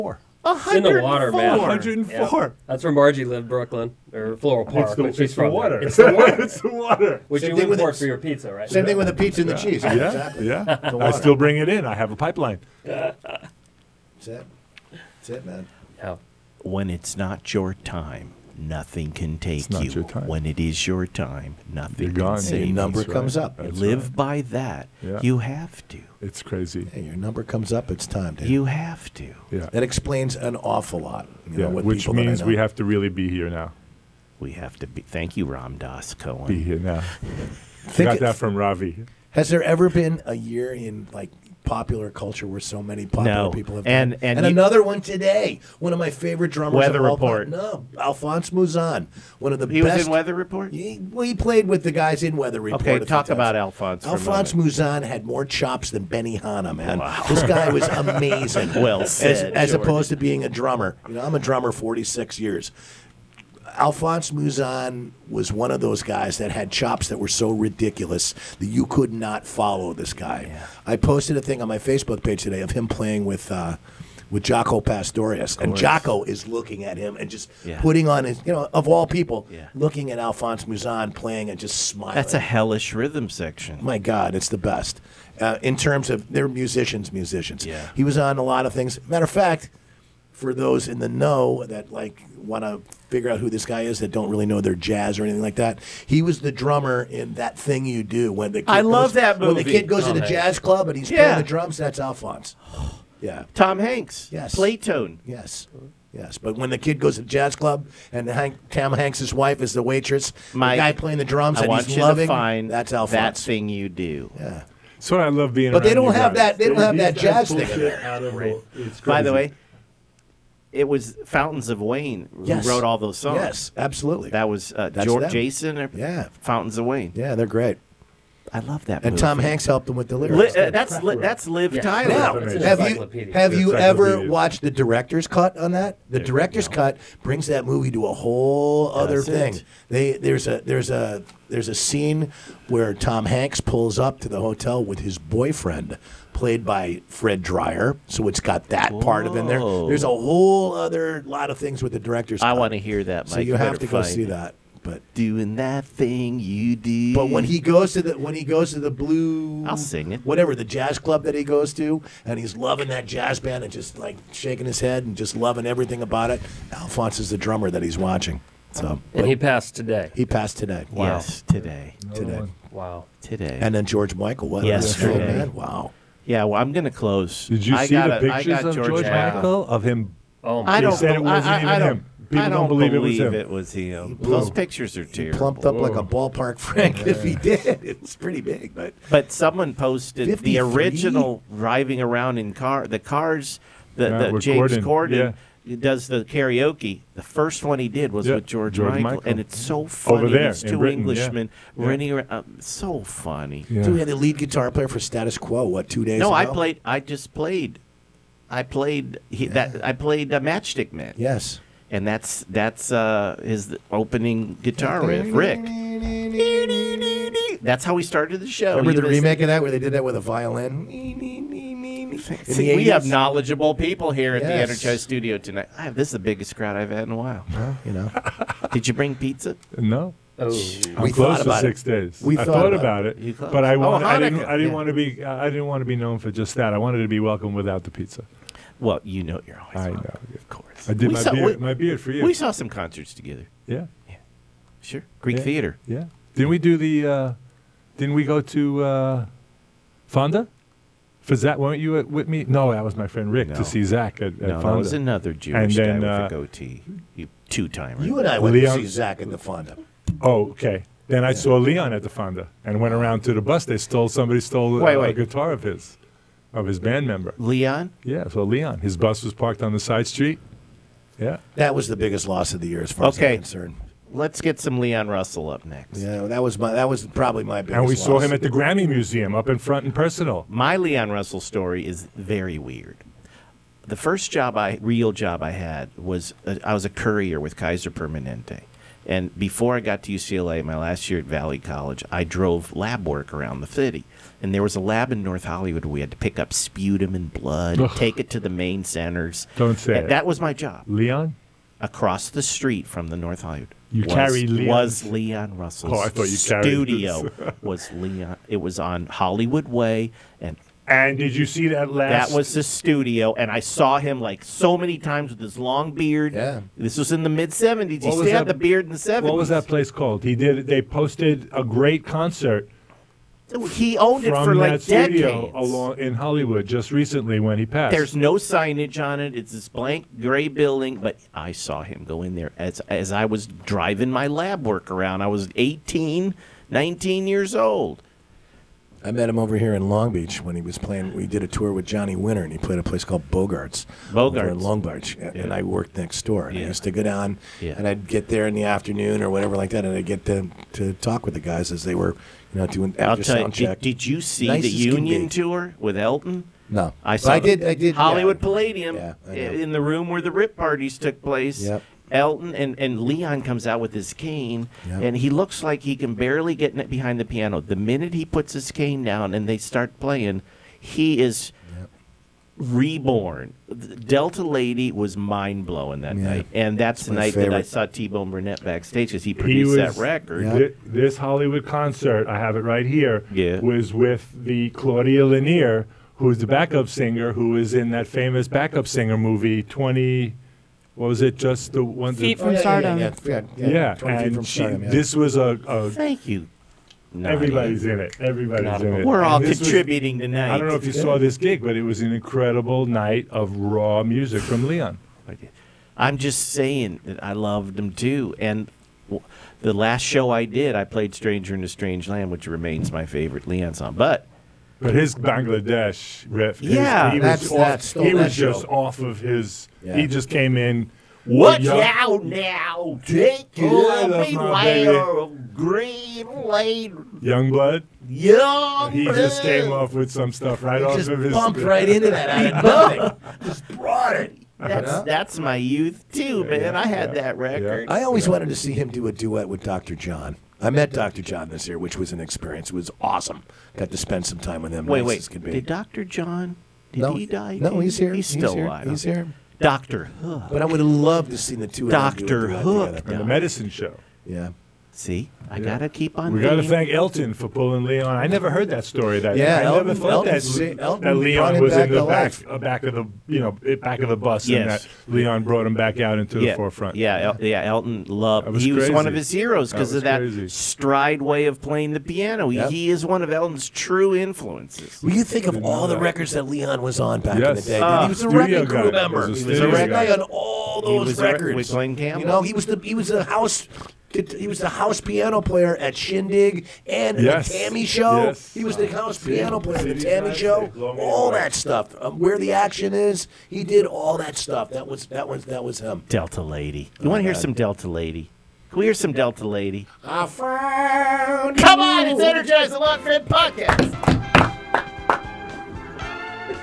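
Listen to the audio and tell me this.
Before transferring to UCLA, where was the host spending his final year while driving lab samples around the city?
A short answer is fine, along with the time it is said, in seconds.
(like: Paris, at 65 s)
Valley College, at 291 s.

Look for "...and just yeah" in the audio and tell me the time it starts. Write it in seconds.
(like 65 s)
77 s.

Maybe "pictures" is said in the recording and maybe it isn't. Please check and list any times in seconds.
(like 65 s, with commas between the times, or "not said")
178 s, 184 s.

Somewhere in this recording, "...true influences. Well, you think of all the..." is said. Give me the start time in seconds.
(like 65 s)
473 s.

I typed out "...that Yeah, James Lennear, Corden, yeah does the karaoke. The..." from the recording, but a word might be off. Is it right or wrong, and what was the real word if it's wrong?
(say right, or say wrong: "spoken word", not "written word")
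wrong: "Corden", not "Lennear".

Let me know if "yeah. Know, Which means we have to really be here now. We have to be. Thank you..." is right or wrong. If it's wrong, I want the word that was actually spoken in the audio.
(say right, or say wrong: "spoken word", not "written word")
right.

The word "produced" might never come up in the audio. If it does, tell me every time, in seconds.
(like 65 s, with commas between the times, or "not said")
379 s.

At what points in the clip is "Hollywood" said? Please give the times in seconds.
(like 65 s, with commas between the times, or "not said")
295 s, 303 s, 309 s, 326 s, 358 s, 381 s.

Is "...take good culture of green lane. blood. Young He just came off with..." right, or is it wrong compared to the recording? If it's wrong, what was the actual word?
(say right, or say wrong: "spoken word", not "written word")
wrong: "beware", not "culture".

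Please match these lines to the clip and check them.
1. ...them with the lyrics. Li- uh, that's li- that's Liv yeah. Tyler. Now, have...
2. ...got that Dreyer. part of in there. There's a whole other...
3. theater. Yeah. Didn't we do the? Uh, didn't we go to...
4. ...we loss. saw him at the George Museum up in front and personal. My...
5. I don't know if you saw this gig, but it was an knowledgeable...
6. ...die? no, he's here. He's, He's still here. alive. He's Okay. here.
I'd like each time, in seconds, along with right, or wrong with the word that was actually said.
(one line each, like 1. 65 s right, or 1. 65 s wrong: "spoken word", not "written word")
1. 129 s right
2. 148 s wrong: "Whoa", not "Dreyer"
3. 245 s right
4. 277 s wrong: "Grammy", not "George"
5. 400 s wrong: "incredible", not "knowledgeable"
6. 447 s right.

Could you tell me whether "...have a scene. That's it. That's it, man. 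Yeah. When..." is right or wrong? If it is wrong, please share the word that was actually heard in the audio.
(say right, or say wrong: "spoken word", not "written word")
wrong: "pipeline", not "scene".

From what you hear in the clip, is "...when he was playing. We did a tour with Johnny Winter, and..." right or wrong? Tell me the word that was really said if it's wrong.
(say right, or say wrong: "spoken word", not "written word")
right.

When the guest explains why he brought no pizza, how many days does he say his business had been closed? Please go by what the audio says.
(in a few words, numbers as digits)
6.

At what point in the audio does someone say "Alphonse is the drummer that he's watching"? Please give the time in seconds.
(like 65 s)
166 s.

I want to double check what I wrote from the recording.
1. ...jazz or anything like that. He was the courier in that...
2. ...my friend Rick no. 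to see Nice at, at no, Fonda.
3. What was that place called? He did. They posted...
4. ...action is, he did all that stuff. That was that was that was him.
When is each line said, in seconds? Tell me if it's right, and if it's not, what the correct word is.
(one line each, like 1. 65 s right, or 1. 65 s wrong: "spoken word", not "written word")
1. 94 s wrong: "drummer", not "courier"
2. 252 s wrong: "Zach", not "Nice"
3. 319 s right
4. 492 s right.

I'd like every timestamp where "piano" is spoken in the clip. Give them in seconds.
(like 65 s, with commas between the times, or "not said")
367 s, 472 s, 485 s, 489 s.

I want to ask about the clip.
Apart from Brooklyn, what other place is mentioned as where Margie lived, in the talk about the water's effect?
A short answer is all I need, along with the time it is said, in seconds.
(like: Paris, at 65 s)
Floral Park, at 4 s.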